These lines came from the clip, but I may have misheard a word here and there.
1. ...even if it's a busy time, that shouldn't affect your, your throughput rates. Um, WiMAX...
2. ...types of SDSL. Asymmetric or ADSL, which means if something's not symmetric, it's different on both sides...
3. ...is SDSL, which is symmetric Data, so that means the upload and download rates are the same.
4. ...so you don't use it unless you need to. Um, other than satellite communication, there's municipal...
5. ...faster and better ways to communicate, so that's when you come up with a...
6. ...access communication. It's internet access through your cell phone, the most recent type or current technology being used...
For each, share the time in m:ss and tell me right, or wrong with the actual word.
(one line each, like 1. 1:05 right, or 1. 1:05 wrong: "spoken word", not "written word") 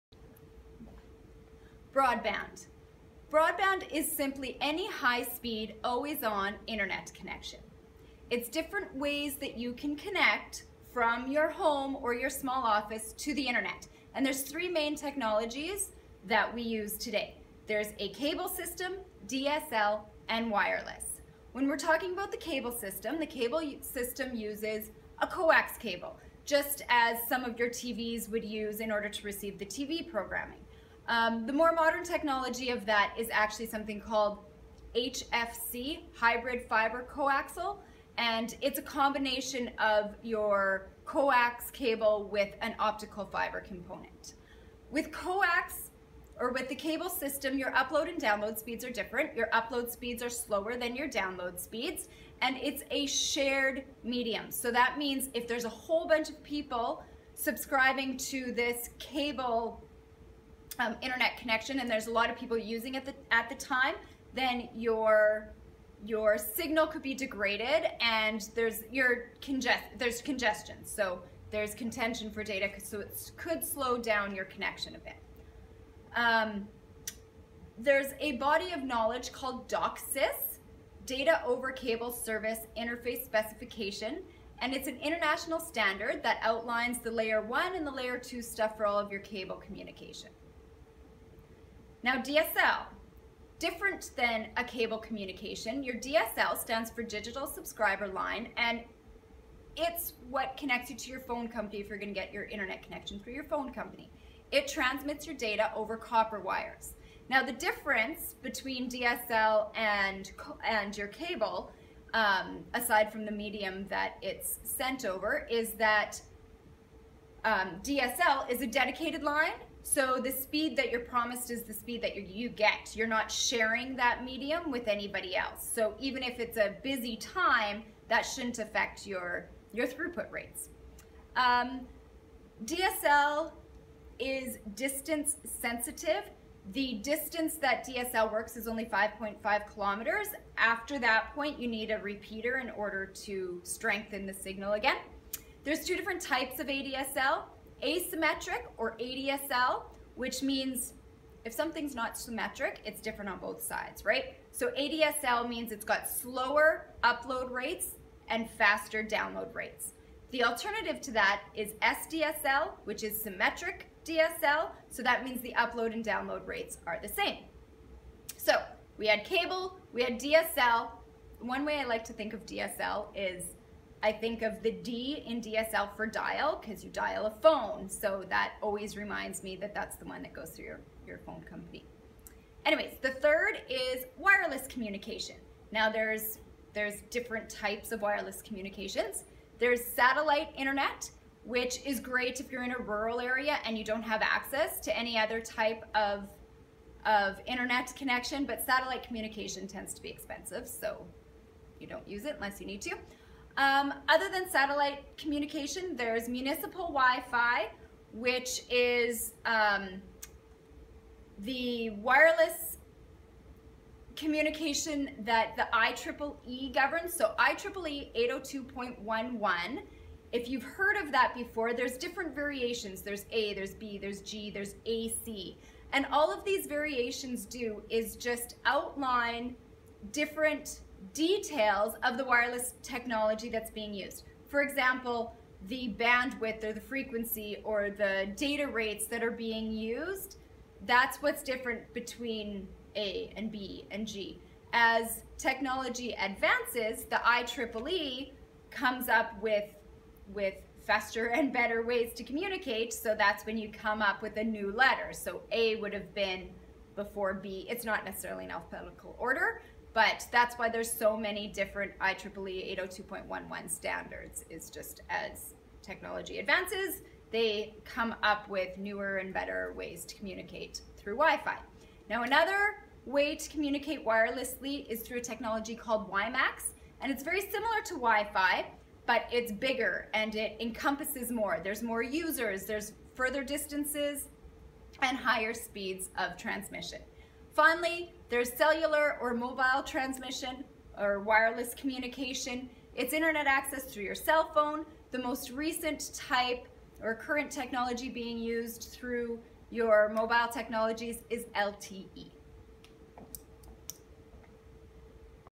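1. 2:05 wrong: "DSL", not "WiMAX"
2. 2:26 wrong: "ADSL", not "SDSL"
3. 2:41 wrong: "DSL", not "Data"
4. 3:20 right
5. 4:10 right
6. 4:51 wrong: "wireless", not "access".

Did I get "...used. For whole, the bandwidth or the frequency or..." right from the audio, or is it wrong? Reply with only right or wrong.
wrong.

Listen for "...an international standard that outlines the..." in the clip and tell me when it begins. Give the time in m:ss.
1:24.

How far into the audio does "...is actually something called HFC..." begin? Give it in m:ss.
0:33.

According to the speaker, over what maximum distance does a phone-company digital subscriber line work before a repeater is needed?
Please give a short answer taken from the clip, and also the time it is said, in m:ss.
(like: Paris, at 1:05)
5.5 kilometers, at 2:18.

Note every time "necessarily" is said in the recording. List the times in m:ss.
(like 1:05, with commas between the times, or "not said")
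4:18.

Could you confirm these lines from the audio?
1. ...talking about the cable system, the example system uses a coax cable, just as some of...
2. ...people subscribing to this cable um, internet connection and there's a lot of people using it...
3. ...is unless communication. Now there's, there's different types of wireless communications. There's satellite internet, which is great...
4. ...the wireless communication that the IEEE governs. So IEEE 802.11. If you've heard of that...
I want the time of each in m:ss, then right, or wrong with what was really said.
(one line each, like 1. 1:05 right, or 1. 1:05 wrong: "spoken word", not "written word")
1. 0:21 wrong: "cable", not "example"
2. 0:56 right
3. 3:03 wrong: "wireless", not "unless"
4. 3:31 right.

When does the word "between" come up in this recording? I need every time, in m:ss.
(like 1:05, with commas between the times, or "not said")
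1:48, 4:01.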